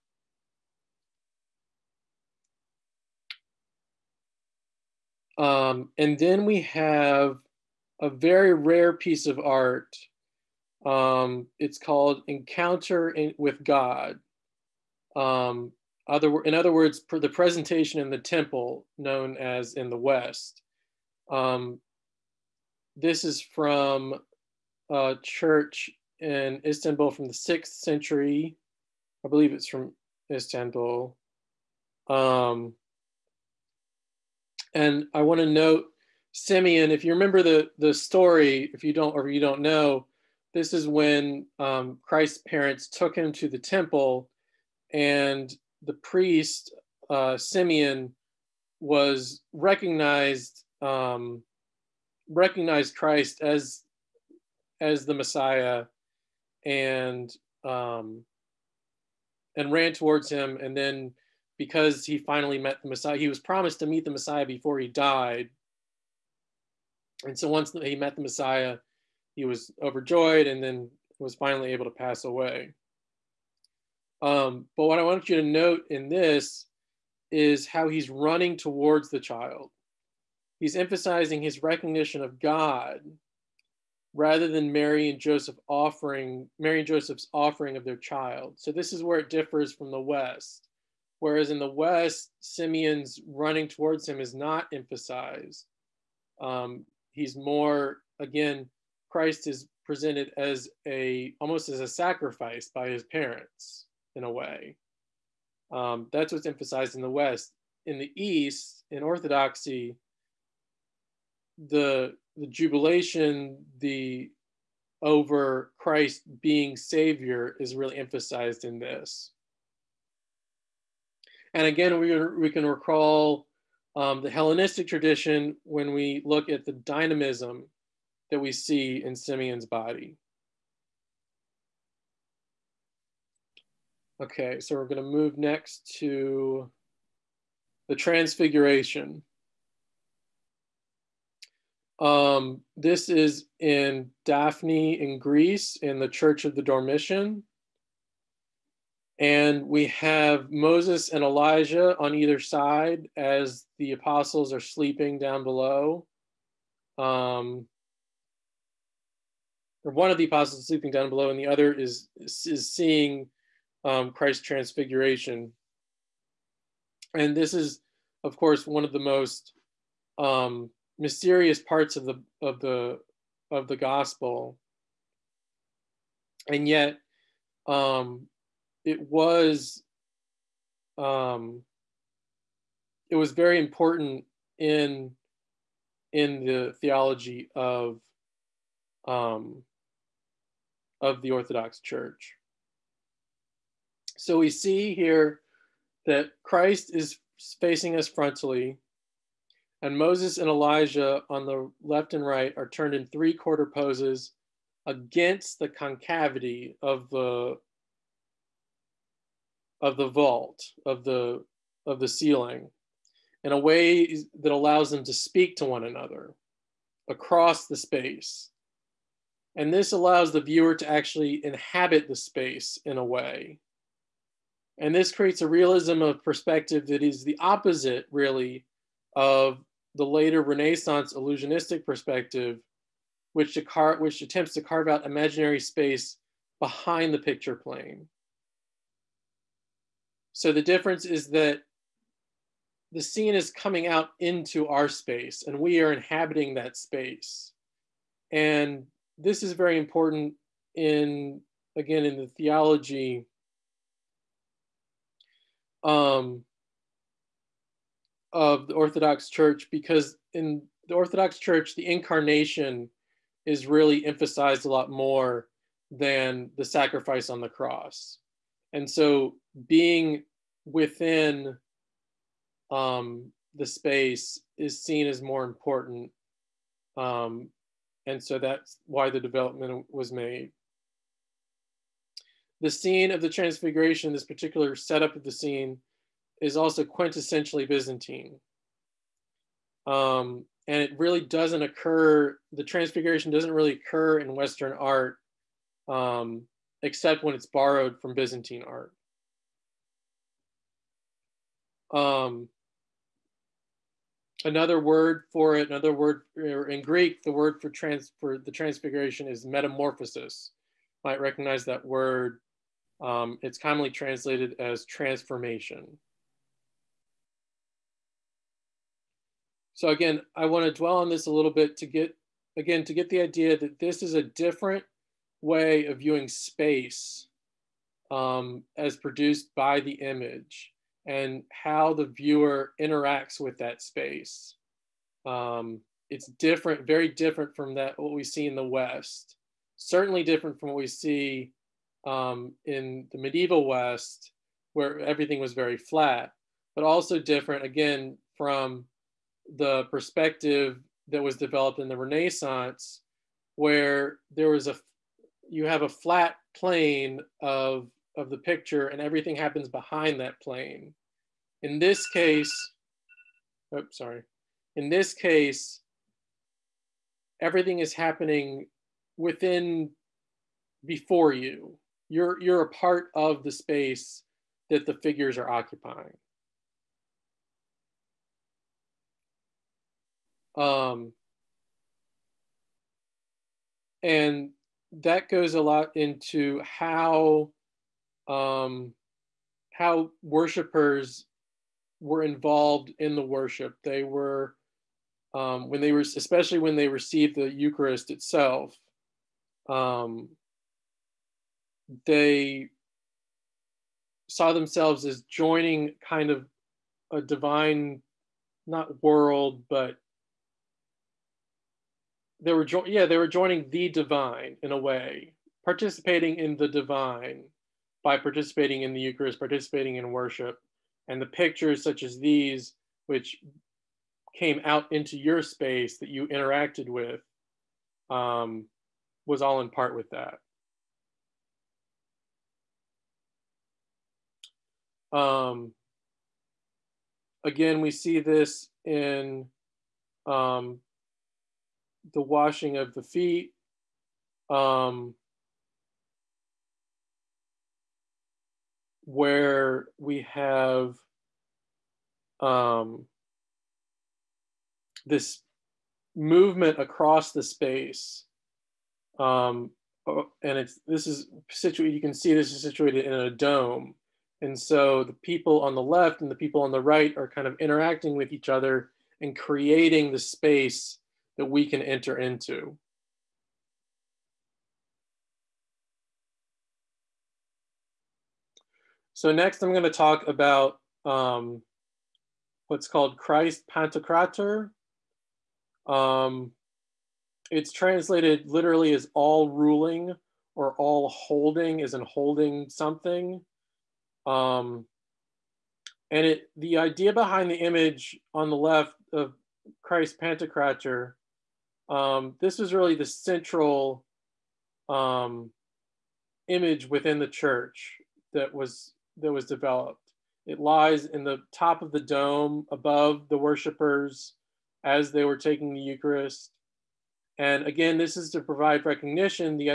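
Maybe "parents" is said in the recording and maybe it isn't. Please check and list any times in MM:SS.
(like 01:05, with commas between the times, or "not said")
00:42, 01:43.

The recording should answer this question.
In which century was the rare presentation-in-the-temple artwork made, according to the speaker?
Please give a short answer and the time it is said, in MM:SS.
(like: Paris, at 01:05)
6th century, at 00:27.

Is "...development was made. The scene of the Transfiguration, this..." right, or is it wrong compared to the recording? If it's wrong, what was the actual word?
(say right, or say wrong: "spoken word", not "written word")
right.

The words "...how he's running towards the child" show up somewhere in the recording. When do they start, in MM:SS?
01:17.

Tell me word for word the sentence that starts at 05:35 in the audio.
Um, it's different, very different from that what we see in the West.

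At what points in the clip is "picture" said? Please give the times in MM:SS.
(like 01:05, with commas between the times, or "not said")
03:57, 05:58, 07:01.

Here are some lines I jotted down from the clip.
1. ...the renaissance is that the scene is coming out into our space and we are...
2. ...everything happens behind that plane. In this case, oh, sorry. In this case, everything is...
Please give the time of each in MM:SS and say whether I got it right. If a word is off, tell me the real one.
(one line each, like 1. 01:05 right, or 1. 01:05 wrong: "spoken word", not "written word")
1. 04:00 wrong: "difference", not "renaissance"
2. 05:59 right.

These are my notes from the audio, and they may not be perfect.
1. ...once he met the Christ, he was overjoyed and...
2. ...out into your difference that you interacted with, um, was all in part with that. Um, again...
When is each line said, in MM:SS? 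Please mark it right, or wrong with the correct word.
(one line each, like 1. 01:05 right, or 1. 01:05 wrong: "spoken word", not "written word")
1. 01:07 wrong: "Messiah", not "Christ"
2. 07:04 wrong: "space", not "difference".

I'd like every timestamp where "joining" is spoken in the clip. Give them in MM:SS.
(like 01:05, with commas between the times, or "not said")
06:45, 06:53.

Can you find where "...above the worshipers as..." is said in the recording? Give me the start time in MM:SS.
08:32.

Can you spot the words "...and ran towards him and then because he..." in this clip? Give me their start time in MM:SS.
00:59.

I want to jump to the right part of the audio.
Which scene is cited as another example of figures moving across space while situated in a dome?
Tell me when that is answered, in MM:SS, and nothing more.
07:22.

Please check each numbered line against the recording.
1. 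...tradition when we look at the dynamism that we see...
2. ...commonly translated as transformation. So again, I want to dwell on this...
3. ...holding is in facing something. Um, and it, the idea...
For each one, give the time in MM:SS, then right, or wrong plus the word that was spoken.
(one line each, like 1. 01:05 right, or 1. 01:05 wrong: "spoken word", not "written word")
1. 02:04 right
2. 05:13 right
3. 08:11 wrong: "holding", not "facing".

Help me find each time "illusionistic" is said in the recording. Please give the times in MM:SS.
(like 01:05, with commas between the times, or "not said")
03:51.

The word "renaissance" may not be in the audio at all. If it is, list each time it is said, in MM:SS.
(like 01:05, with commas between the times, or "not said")
03:50, 05:51.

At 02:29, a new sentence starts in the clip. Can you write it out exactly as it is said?
And we have Moses and Elijah on either side as the apostles are sleeping down below.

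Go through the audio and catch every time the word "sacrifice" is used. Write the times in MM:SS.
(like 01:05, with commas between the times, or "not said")
01:41, 04:26.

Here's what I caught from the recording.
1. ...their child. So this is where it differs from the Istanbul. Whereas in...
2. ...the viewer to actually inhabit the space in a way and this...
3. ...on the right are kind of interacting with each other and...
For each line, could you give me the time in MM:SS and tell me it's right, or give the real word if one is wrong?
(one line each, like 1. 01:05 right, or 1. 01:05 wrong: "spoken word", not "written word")
1. 01:27 wrong: "West", not "Istanbul"
2. 03:40 right
3. 07:46 right.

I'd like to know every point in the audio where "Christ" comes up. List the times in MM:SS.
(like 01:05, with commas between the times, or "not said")
00:42, 00:52, 01:39, 01:55, 02:44, 03:16, 08:03, 08:19.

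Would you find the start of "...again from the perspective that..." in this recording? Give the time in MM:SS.
05:47.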